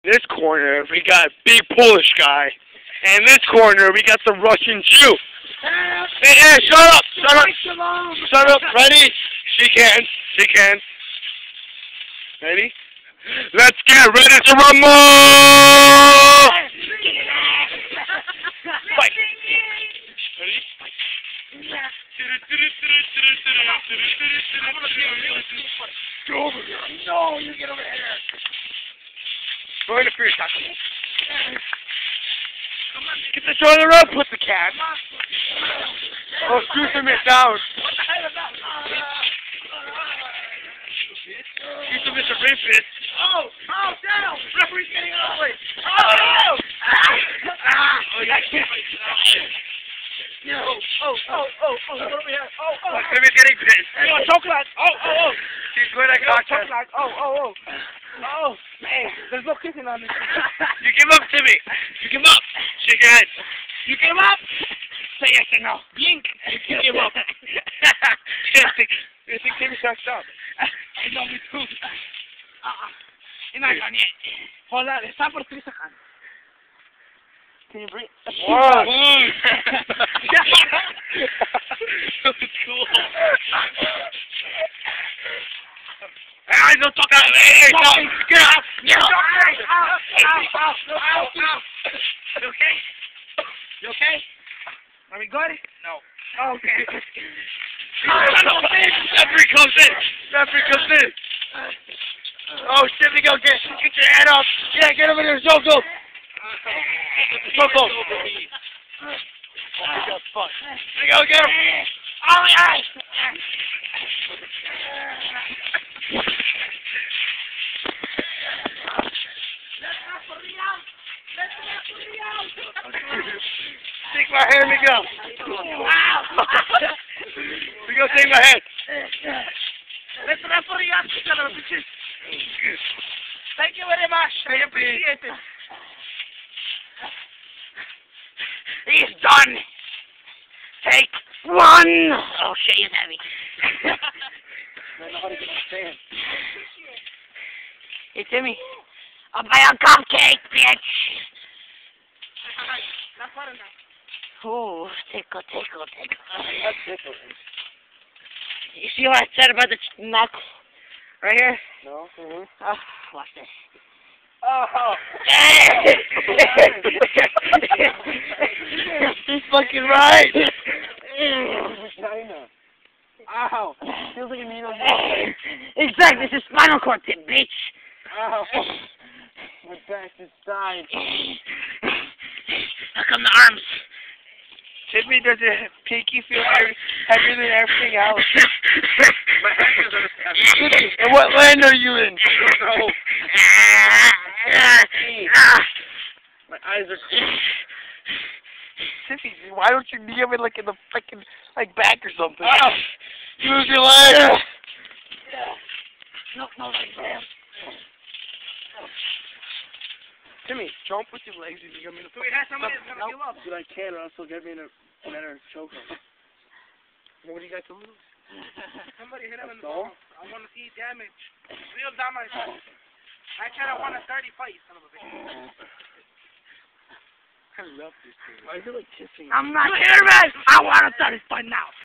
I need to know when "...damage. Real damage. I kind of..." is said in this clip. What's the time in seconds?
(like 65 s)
220 s.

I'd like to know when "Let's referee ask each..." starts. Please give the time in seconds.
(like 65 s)
130 s.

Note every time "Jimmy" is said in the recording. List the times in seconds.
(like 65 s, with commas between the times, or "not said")
53 s.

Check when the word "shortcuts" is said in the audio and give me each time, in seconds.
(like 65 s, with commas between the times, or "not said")
not said.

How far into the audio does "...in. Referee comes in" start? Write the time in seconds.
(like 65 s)
99 s.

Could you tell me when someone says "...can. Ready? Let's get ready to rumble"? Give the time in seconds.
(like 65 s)
10 s.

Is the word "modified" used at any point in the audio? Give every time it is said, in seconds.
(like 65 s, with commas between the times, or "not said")
not said.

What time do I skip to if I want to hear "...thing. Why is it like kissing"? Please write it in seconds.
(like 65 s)
228 s.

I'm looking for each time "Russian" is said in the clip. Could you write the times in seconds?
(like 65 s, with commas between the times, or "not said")
4 s.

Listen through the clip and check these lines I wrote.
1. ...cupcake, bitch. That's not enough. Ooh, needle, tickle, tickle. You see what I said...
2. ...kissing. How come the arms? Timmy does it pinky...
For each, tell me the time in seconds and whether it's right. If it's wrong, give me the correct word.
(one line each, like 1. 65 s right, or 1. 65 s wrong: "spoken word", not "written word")
1. 149 s wrong: "tickle", not "needle"
2. 180 s wrong: "dying", not "kissing".